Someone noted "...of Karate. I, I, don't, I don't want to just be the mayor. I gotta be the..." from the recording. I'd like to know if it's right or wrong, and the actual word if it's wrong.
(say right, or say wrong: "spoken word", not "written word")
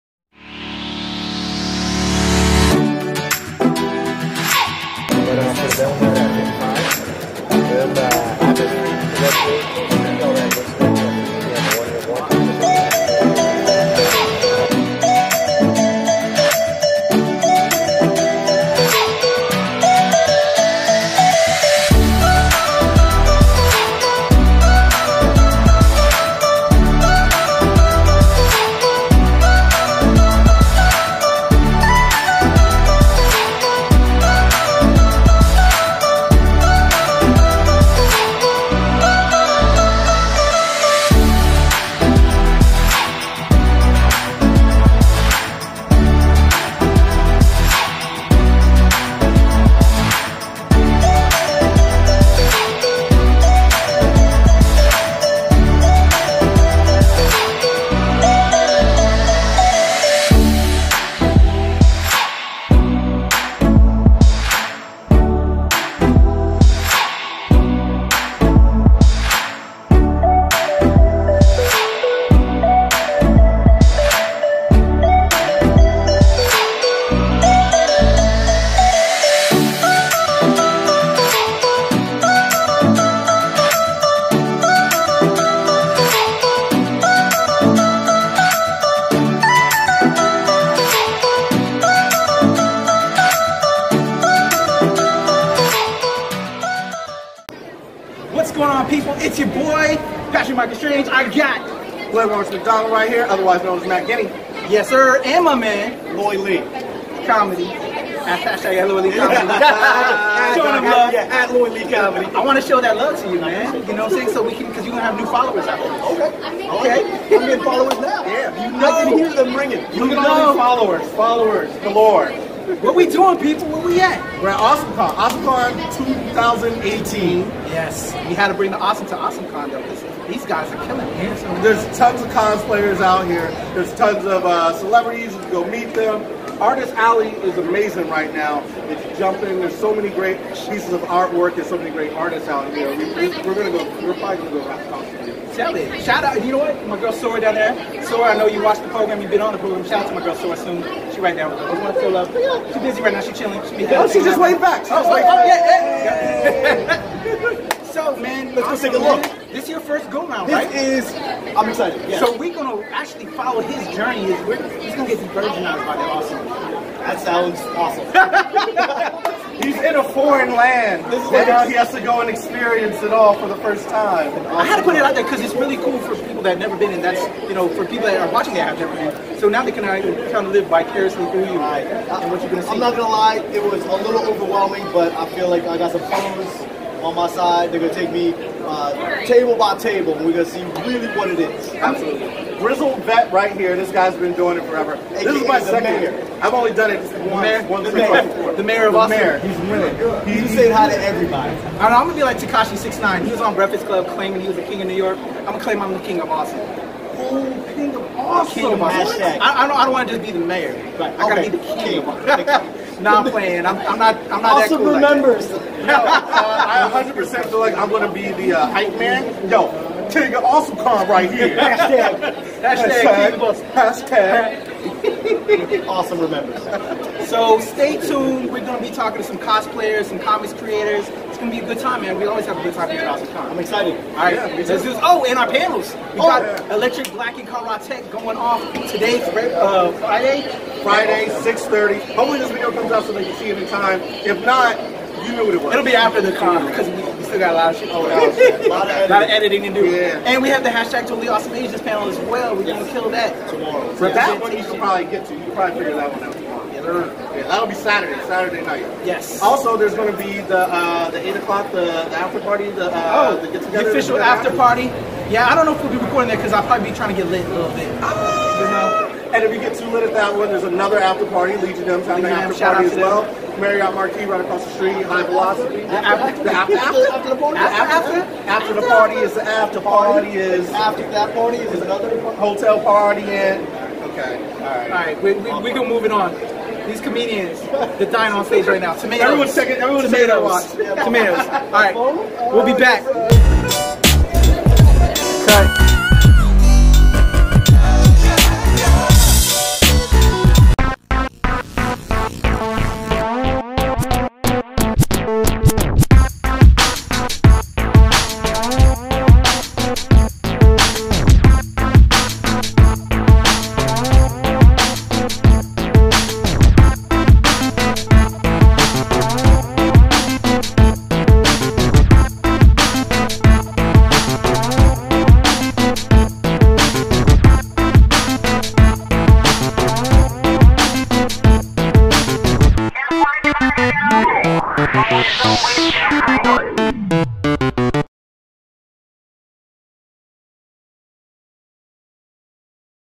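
wrong: "Austin", not "Karate".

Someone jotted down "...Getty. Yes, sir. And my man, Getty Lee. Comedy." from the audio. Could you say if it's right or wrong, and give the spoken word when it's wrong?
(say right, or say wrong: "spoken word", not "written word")
wrong: "Lloyd", not "Getty".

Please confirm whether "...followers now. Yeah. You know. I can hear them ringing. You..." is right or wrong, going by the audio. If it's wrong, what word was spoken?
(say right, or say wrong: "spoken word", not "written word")
right.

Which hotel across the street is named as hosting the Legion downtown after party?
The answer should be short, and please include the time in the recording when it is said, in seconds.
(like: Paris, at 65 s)
Marriott Marquis, at 273 s.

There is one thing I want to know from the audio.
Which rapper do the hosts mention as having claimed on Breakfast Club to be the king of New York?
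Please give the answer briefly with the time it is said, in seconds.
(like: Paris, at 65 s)
Tekashi 69, at 202 s.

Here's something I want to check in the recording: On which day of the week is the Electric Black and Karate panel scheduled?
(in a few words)
Friday.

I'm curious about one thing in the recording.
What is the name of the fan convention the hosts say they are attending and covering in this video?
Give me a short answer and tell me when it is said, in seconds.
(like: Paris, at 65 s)
AwesomeCon 2018, at 125 s.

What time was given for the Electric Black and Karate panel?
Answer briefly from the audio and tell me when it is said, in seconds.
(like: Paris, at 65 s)
6:30, at 241 s.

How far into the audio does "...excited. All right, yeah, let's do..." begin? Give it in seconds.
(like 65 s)
233 s.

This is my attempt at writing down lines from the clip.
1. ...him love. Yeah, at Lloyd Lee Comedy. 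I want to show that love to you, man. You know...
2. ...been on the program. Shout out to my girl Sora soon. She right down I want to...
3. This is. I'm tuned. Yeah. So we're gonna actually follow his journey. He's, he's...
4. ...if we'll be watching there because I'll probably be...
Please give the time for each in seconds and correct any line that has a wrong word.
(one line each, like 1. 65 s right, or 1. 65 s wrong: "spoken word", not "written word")
1. 110 s right
2. 149 s right
3. 160 s wrong: "excited", not "tuned"
4. 265 s wrong: "recording", not "watching".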